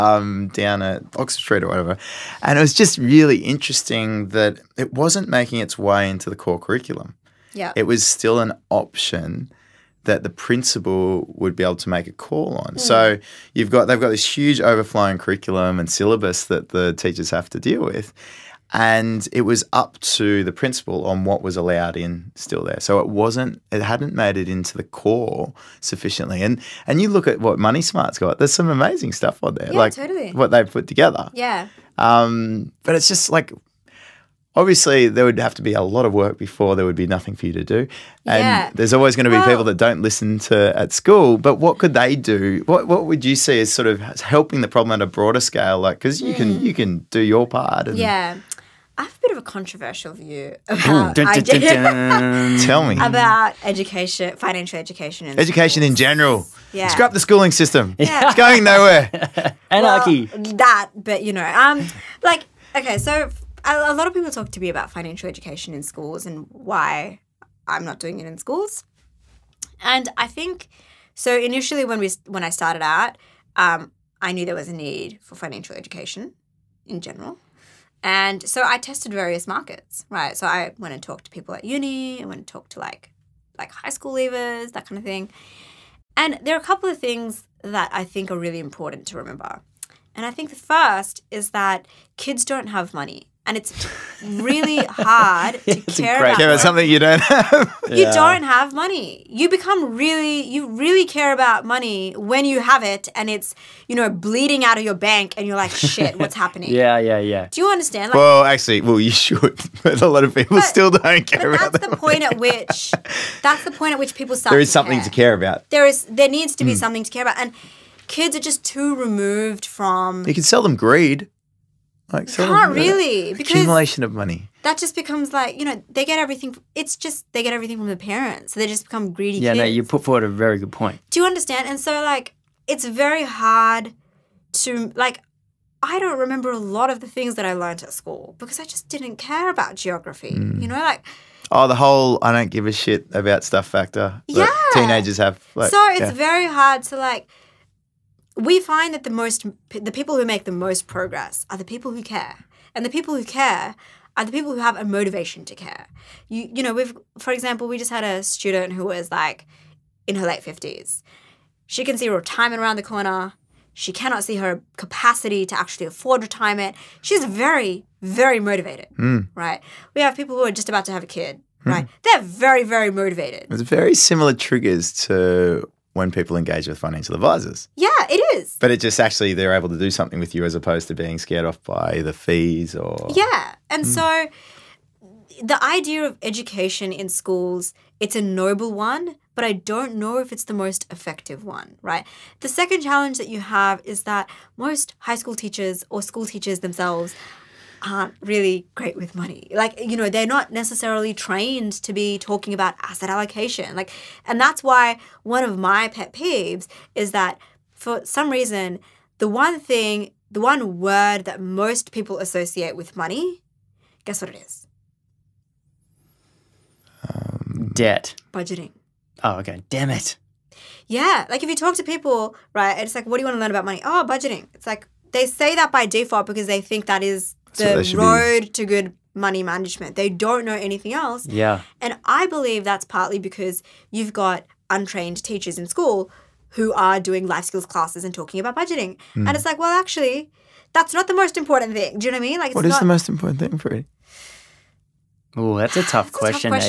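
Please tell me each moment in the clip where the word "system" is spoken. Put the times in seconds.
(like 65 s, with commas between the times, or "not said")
57 s.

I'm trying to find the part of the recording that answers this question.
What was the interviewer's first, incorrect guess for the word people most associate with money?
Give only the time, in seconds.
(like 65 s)
217 s.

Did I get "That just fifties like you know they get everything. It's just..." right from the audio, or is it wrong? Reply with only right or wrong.
wrong.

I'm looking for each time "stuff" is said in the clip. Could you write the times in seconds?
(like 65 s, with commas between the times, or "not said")
29 s, 143 s.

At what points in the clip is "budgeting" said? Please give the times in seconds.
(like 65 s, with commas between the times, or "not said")
218 s, 224 s, 238 s.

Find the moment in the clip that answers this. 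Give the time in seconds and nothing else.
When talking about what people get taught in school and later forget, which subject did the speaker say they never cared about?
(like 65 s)
139 s.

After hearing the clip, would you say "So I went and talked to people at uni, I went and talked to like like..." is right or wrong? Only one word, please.
right.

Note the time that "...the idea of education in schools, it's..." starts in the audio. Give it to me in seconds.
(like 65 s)
185 s.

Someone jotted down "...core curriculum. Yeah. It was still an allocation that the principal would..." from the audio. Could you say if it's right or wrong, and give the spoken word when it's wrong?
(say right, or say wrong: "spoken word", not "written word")
wrong: "option", not "allocation".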